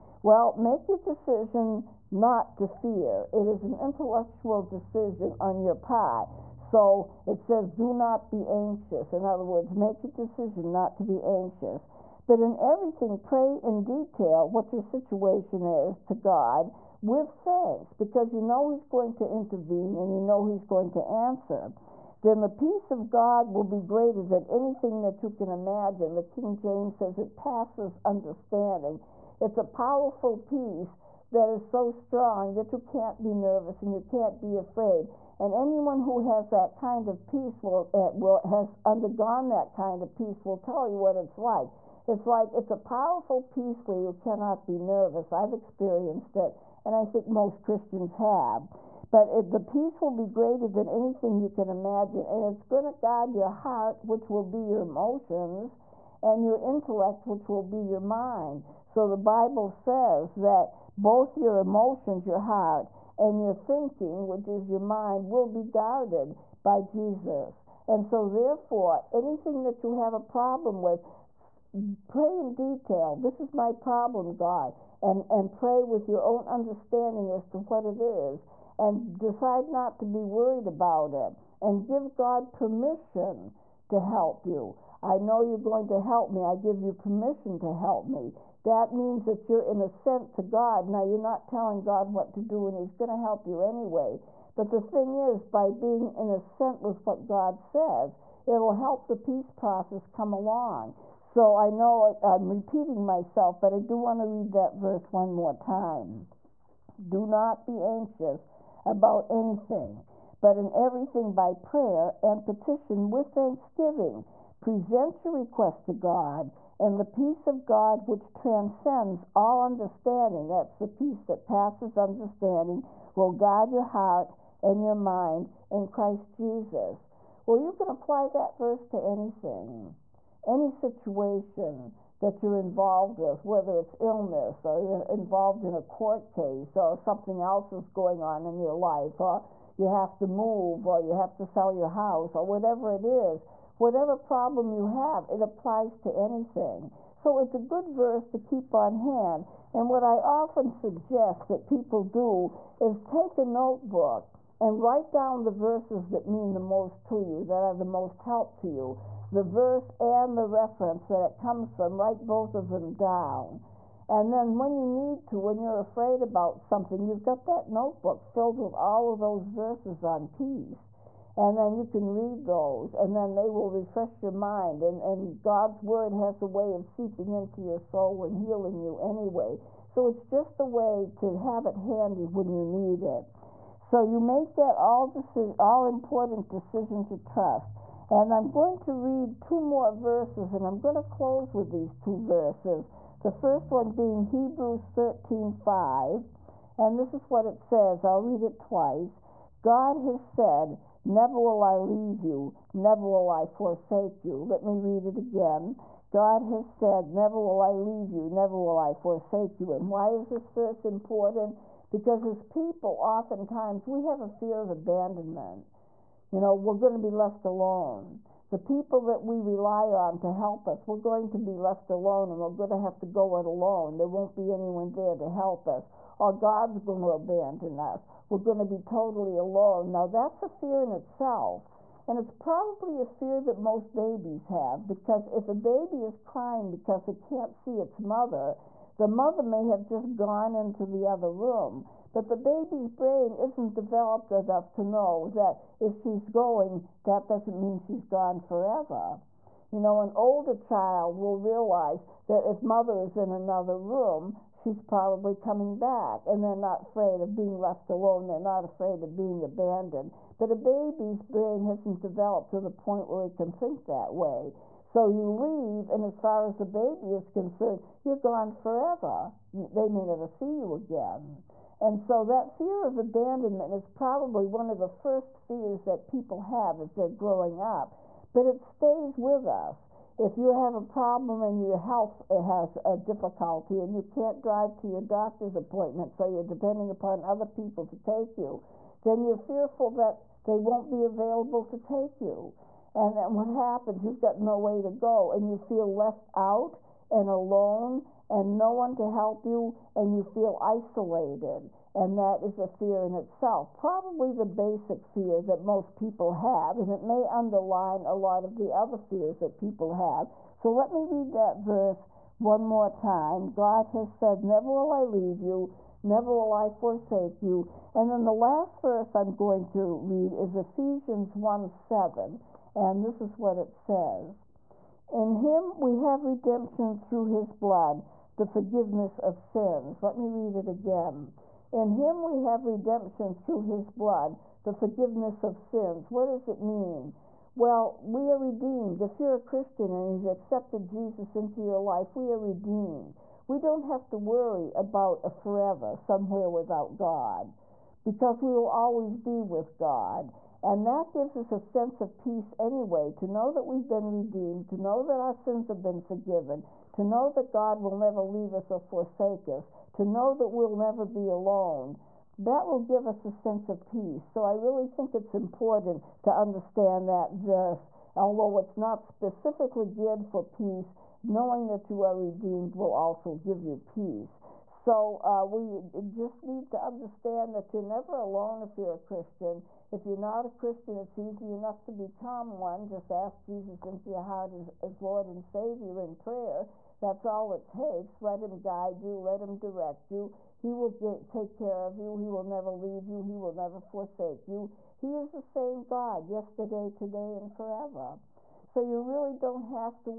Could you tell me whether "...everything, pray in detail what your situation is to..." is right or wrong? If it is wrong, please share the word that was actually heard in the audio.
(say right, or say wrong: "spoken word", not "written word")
right.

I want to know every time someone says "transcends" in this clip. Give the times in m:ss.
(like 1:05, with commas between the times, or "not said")
1:58.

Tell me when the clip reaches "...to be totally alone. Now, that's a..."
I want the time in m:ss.
3:48.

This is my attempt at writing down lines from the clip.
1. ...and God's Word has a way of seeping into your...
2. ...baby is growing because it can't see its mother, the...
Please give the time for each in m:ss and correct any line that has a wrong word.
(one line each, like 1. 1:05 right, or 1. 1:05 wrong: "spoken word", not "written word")
1. 2:55 right
2. 3:55 wrong: "crying", not "growing".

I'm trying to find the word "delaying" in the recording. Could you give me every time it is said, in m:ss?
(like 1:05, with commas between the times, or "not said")
not said.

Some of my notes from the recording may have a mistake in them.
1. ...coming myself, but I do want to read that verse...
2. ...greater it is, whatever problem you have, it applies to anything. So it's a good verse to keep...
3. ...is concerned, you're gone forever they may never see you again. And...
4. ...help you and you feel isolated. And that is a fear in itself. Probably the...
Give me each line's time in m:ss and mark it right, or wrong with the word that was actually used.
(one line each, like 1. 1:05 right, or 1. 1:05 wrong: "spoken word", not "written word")
1. 1:42 wrong: "repeating", not "coming"
2. 2:22 wrong: "whatever", not "greater"
3. 4:27 right
4. 4:59 right.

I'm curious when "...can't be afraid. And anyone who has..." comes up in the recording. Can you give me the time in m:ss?
0:34.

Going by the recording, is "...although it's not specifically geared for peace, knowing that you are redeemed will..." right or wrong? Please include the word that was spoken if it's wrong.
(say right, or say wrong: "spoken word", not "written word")
right.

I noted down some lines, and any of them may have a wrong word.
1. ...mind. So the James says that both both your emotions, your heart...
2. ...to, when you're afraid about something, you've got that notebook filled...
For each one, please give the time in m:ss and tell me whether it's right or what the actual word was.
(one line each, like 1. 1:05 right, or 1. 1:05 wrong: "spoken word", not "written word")
1. 0:57 wrong: "Bible", not "James"
2. 2:45 right.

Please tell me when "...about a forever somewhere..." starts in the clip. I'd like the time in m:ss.
5:44.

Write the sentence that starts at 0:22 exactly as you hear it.
Then the peace of God will be greater than anything that you can imagine.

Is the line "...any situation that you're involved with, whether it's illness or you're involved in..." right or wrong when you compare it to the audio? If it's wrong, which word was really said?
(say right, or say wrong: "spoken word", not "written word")
right.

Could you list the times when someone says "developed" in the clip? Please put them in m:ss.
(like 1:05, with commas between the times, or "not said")
4:03, 4:22.